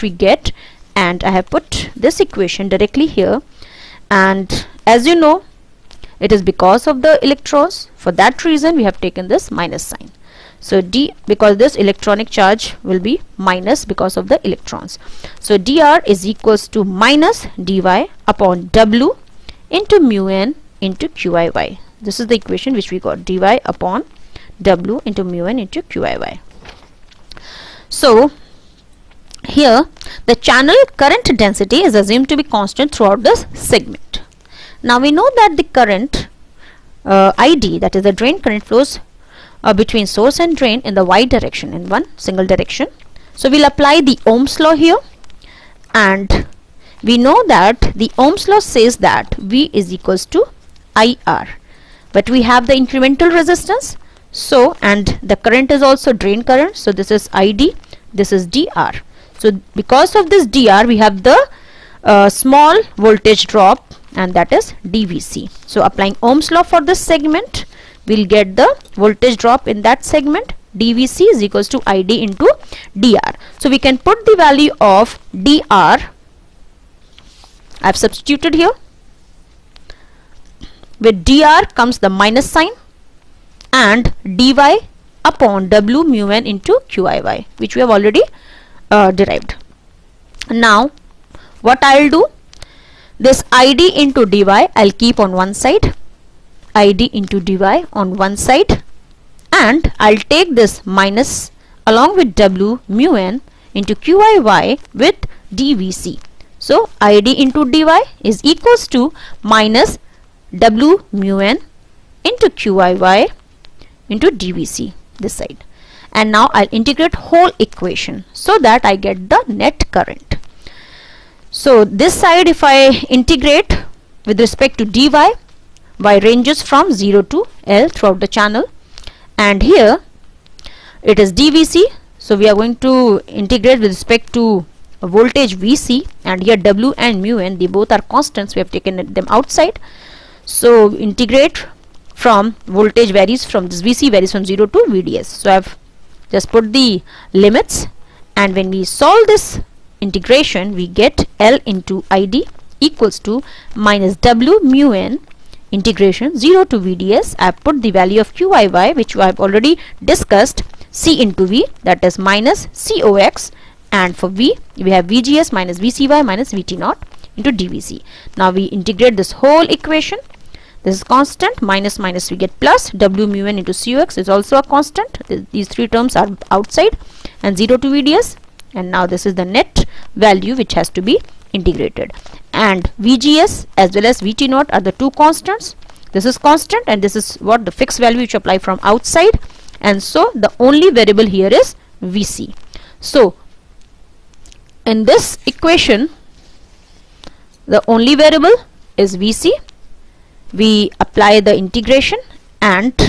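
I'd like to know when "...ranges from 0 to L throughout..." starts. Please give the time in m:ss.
2:06.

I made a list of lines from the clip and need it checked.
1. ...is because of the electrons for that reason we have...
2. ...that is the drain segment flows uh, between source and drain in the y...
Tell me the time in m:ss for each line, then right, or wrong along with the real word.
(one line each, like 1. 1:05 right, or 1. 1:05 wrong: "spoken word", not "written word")
1. 0:06 right
2. 0:37 wrong: "current", not "segment".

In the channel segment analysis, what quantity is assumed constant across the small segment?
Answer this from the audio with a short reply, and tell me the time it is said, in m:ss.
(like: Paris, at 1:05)
channel current density, at 0:30.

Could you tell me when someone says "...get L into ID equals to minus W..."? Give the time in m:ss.
2:30.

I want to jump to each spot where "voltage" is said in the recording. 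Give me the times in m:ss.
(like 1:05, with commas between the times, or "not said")
1:02, 1:08, 2:15, 2:22.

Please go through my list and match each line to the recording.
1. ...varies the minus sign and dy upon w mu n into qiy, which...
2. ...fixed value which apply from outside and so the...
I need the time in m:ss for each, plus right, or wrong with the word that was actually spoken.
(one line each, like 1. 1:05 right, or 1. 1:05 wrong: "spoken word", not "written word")
1. 1:21 wrong: "comes", not "varies"
2. 3:07 right.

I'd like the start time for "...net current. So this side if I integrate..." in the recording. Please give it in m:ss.
1:59.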